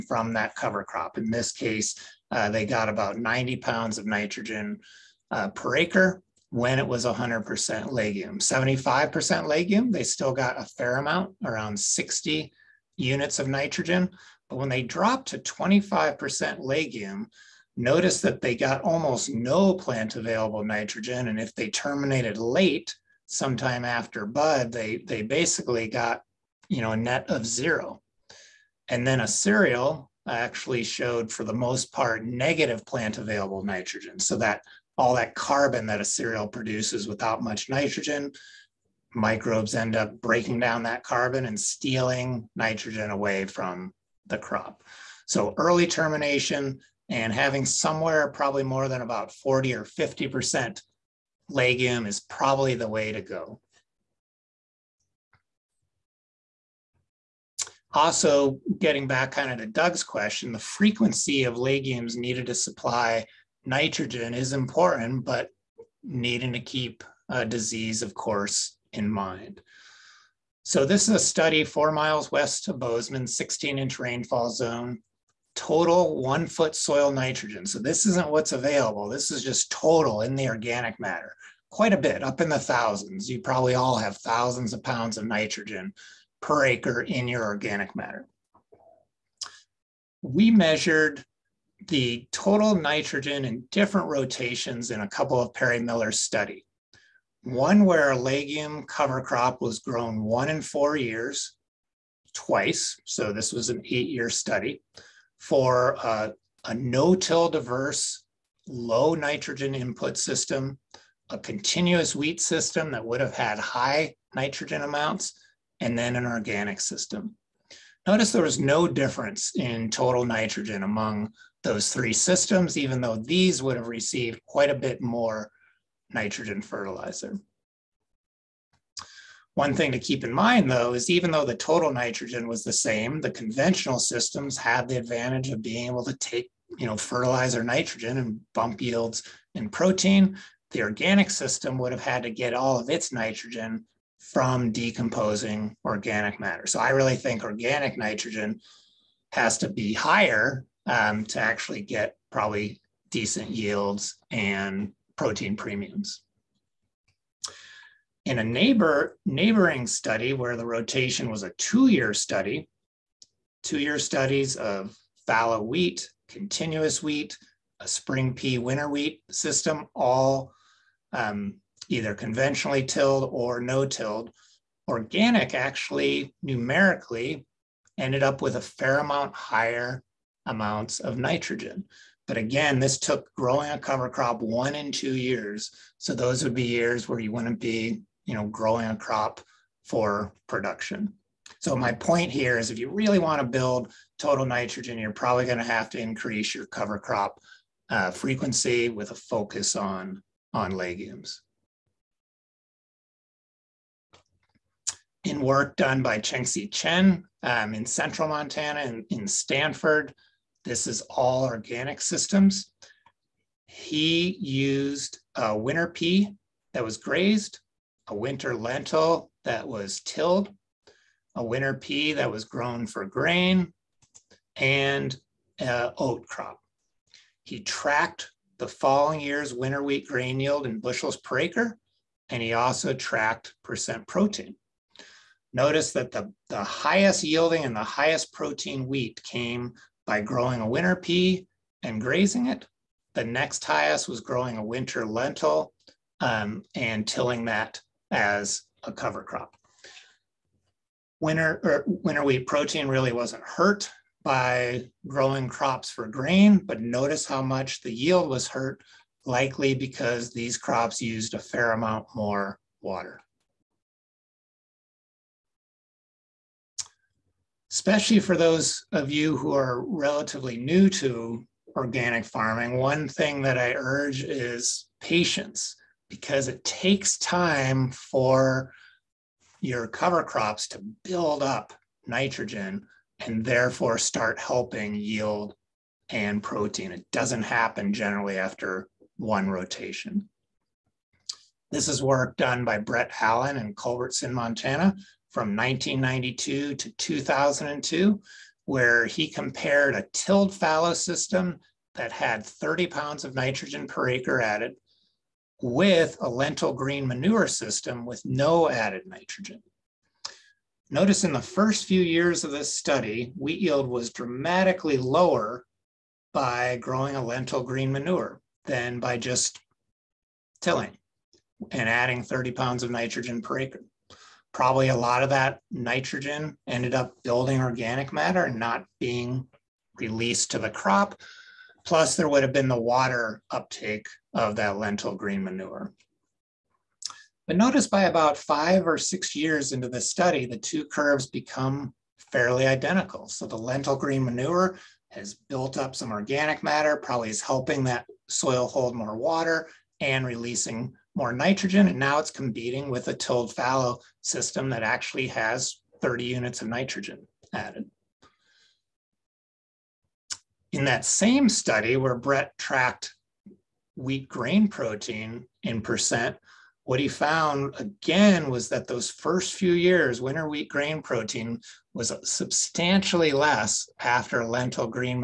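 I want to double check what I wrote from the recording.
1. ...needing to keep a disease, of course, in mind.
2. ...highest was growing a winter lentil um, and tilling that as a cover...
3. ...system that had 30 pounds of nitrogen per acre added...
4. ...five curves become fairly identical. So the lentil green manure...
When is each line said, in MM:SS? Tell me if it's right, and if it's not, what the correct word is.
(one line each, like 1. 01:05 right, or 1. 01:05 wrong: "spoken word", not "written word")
1. 01:06 right
2. 04:03 right
3. 05:00 right
4. 05:40 wrong: "two", not "five".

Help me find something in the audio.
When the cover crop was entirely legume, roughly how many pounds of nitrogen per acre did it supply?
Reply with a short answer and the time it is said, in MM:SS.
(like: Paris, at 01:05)
90 pounds, at 00:03.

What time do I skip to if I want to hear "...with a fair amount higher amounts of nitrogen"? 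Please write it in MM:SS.
02:58.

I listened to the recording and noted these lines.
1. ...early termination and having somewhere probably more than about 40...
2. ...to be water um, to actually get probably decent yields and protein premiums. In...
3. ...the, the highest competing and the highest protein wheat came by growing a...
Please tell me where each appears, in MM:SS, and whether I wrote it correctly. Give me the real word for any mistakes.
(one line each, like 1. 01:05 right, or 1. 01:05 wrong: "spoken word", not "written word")
1. 00:45 right
2. 02:29 wrong: "higher", not "water"
3. 03:56 wrong: "yielding", not "competing".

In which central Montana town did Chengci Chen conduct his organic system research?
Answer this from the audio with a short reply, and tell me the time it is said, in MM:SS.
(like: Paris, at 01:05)
Stanford, at 03:29.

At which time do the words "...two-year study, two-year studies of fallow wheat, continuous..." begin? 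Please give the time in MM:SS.
02:41.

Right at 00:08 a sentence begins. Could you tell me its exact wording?
75% legume, they still got a fair amount, around 60 units of nitrogen.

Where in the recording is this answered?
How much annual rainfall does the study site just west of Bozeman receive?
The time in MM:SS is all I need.
01:13.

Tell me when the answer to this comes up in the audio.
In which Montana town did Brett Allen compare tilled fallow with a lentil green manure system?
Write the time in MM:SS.
04:53.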